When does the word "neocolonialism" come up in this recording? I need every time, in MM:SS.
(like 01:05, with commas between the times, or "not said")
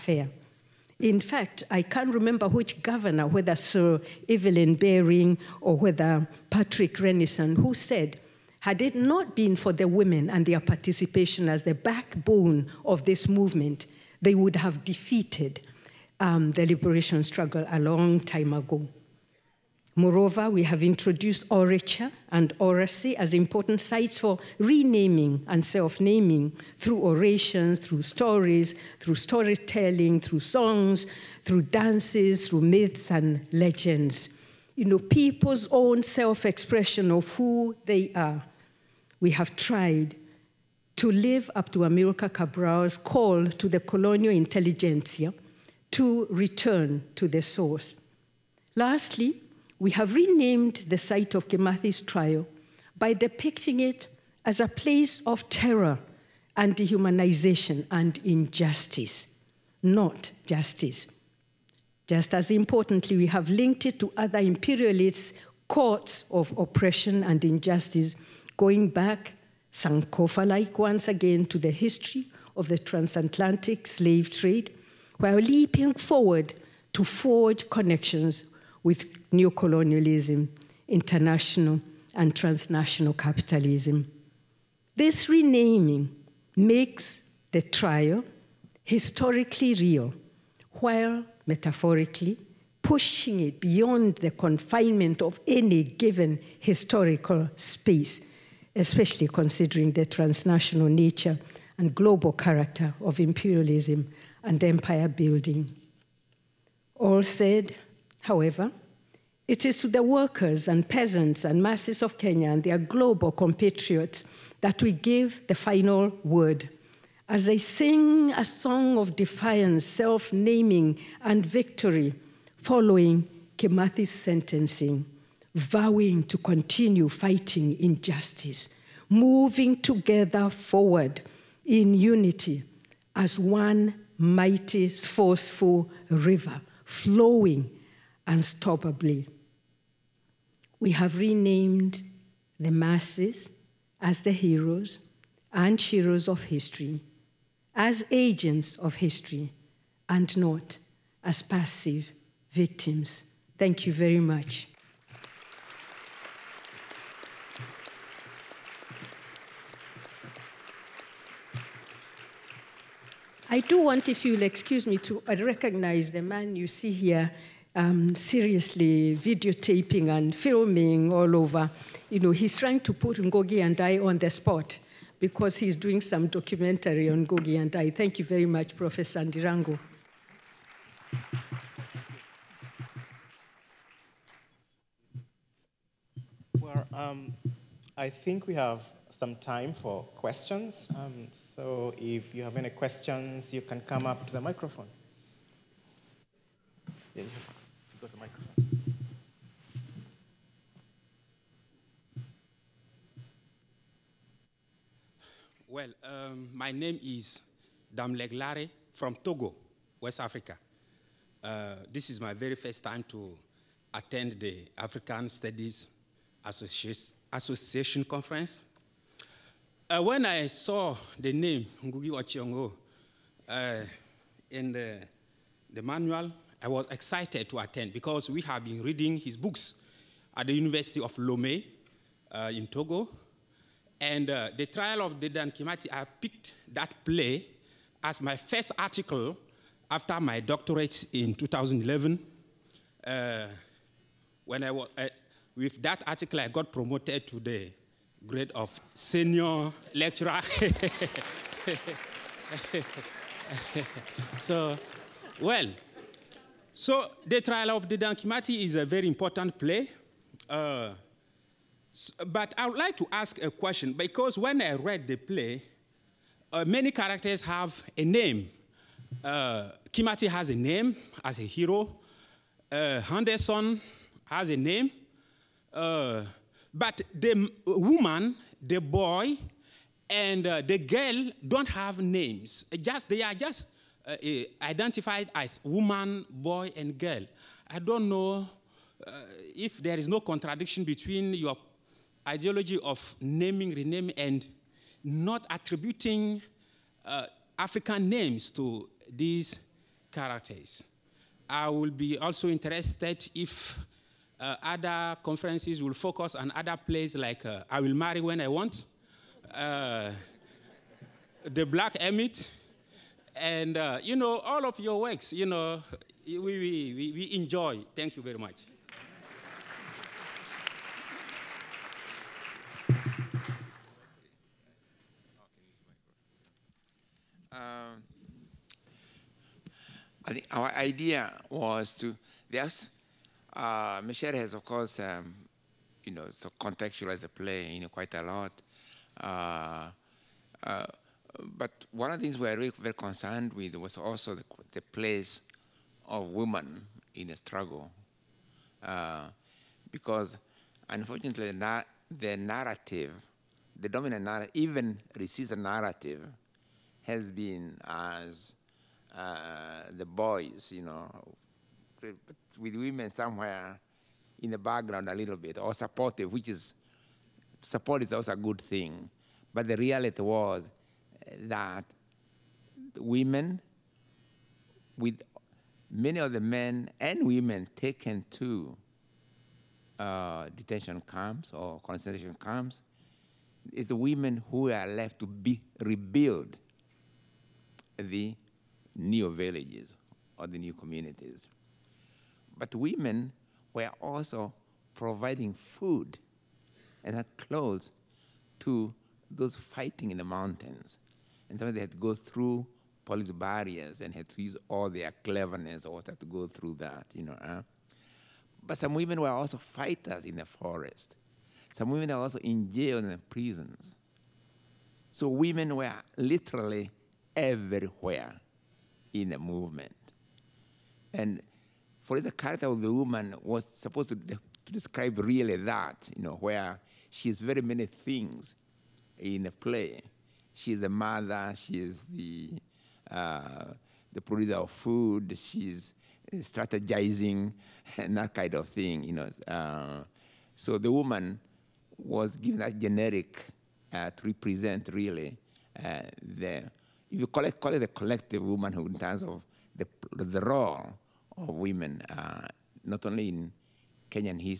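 01:19.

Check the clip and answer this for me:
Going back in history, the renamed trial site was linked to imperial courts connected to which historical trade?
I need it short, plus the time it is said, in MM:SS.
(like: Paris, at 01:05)
transatlantic slave trade, at 01:12.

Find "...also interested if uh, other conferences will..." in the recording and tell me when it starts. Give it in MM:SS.
05:02.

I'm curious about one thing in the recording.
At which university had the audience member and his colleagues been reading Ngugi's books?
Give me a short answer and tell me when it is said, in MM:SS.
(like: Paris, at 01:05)
University of Lomé, at 03:50.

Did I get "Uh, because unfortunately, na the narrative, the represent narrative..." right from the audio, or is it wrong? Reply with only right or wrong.
wrong.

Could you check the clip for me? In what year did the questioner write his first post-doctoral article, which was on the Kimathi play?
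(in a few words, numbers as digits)
2011.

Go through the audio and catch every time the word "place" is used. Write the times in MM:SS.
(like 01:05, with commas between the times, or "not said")
00:54, 05:44.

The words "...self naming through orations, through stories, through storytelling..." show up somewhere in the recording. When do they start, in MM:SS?
00:25.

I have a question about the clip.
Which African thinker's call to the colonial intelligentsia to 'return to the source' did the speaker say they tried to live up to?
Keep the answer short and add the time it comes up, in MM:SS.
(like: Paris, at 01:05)
Amilcar Cabral, at 00:41.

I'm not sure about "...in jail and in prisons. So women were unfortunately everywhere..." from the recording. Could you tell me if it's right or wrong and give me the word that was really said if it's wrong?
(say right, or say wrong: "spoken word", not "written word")
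wrong: "literally", not "unfortunately".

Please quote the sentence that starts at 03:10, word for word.
Um, so if you have any questions, you can come up to the microphone.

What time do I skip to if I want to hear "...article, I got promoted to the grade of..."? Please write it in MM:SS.
04:06.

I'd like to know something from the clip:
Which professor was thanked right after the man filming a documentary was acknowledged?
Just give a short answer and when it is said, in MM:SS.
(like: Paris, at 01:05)
Professor Ndirango, at 02:58.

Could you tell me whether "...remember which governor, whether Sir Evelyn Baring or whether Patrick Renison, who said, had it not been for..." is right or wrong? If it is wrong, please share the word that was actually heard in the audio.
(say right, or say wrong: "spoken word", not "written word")
right.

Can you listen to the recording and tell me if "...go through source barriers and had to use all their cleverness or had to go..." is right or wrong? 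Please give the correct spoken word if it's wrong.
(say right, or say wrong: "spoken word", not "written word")
wrong: "police", not "source".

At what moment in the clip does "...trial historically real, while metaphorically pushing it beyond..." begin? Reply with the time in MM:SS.
01:27.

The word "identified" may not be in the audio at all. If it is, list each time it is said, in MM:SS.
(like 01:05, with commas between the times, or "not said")
04:44.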